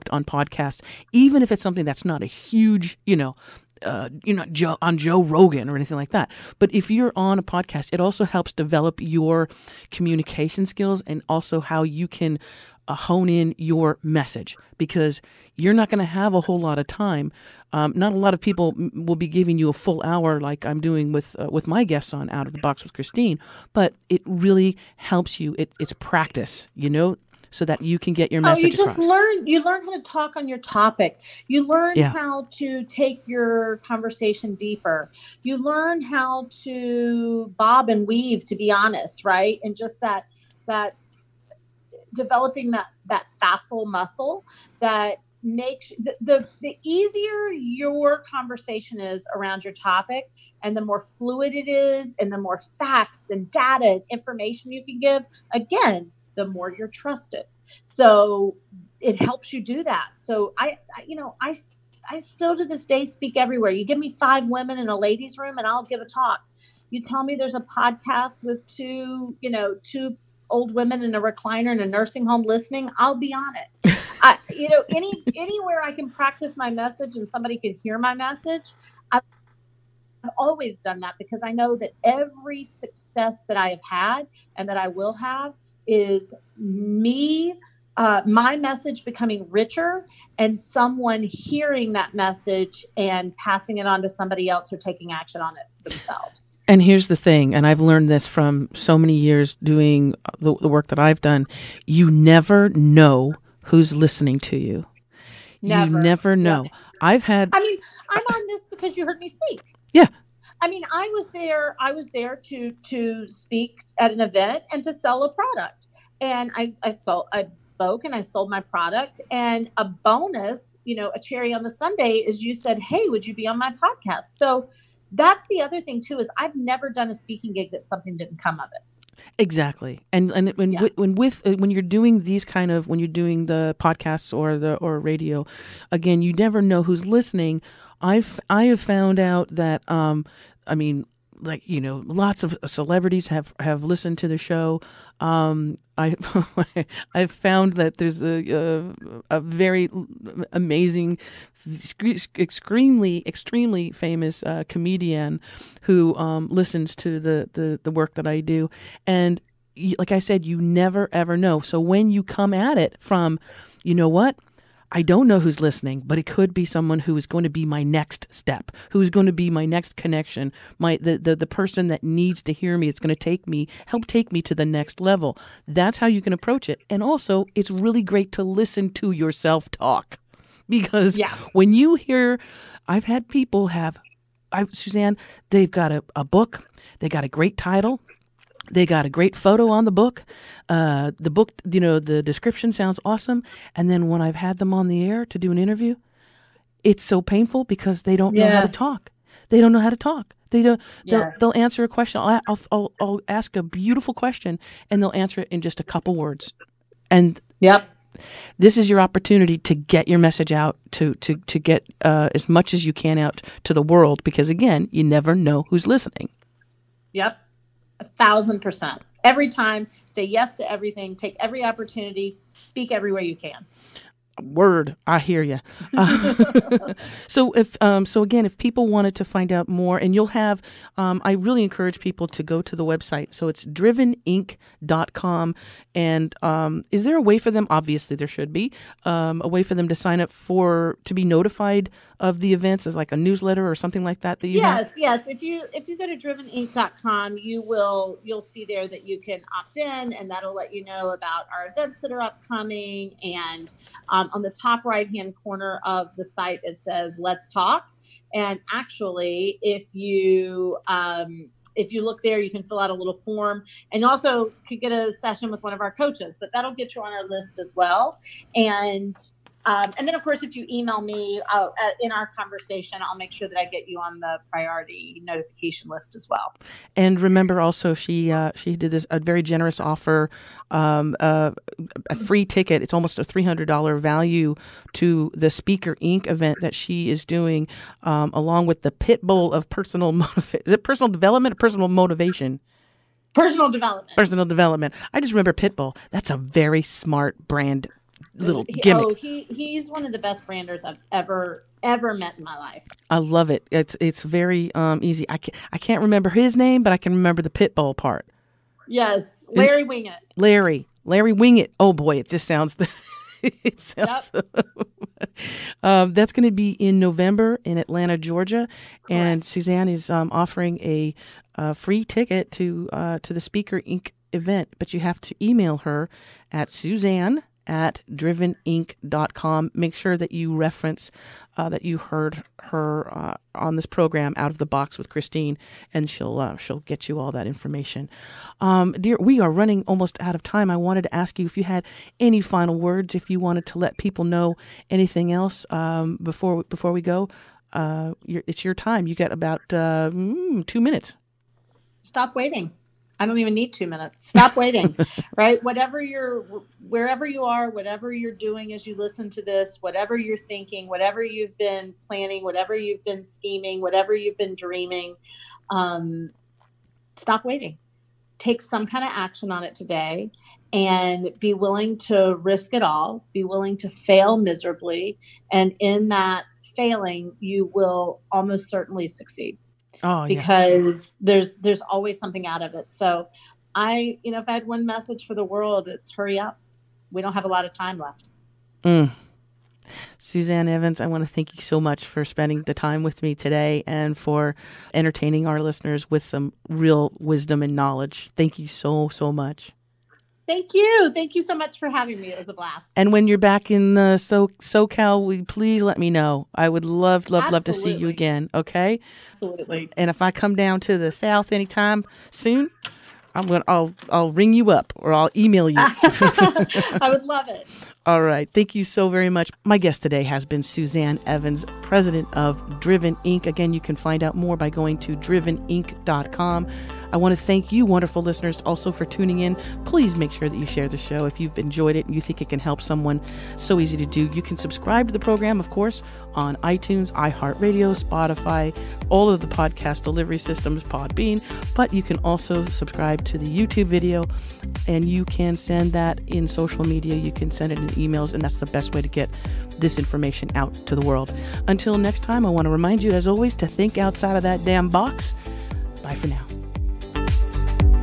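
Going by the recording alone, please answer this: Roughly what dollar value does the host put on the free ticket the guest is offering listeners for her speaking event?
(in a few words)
$300.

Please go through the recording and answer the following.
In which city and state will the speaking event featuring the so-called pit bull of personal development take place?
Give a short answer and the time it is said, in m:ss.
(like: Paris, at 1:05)
Atlanta, Georgia, at 5:17.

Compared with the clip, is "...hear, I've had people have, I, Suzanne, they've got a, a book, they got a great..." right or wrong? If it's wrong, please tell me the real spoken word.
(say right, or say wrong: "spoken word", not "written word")
right.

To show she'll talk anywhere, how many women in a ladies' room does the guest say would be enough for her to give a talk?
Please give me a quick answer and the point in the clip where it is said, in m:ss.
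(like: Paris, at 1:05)
5, at 1:04.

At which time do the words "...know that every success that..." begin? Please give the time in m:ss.
1:21.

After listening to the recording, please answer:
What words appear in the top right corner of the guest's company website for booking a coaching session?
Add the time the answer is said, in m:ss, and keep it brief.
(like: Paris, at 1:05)
Let's Talk, at 4:17.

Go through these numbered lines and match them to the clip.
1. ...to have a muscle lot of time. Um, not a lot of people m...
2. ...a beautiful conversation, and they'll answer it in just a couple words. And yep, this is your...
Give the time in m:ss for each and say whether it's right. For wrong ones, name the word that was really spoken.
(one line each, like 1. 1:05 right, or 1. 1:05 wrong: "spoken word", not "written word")
1. 0:15 wrong: "whole", not "muscle"
2. 3:23 wrong: "question", not "conversation".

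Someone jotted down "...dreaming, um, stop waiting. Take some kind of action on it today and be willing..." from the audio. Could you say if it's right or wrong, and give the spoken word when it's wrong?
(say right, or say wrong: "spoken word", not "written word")
right.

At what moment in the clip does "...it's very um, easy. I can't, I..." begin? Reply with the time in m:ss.
5:03.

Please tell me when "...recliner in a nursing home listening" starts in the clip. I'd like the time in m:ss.
1:11.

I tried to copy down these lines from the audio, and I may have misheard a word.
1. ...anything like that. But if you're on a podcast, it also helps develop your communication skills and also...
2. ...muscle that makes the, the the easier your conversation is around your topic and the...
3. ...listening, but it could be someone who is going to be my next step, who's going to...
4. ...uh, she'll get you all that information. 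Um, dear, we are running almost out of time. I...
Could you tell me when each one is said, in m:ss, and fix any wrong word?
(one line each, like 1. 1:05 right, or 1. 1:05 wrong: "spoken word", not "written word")
1. 0:05 right
2. 0:43 right
3. 2:45 right
4. 5:36 right.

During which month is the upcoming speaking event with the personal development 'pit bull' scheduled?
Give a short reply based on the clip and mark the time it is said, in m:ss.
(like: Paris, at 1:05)
November, at 5:16.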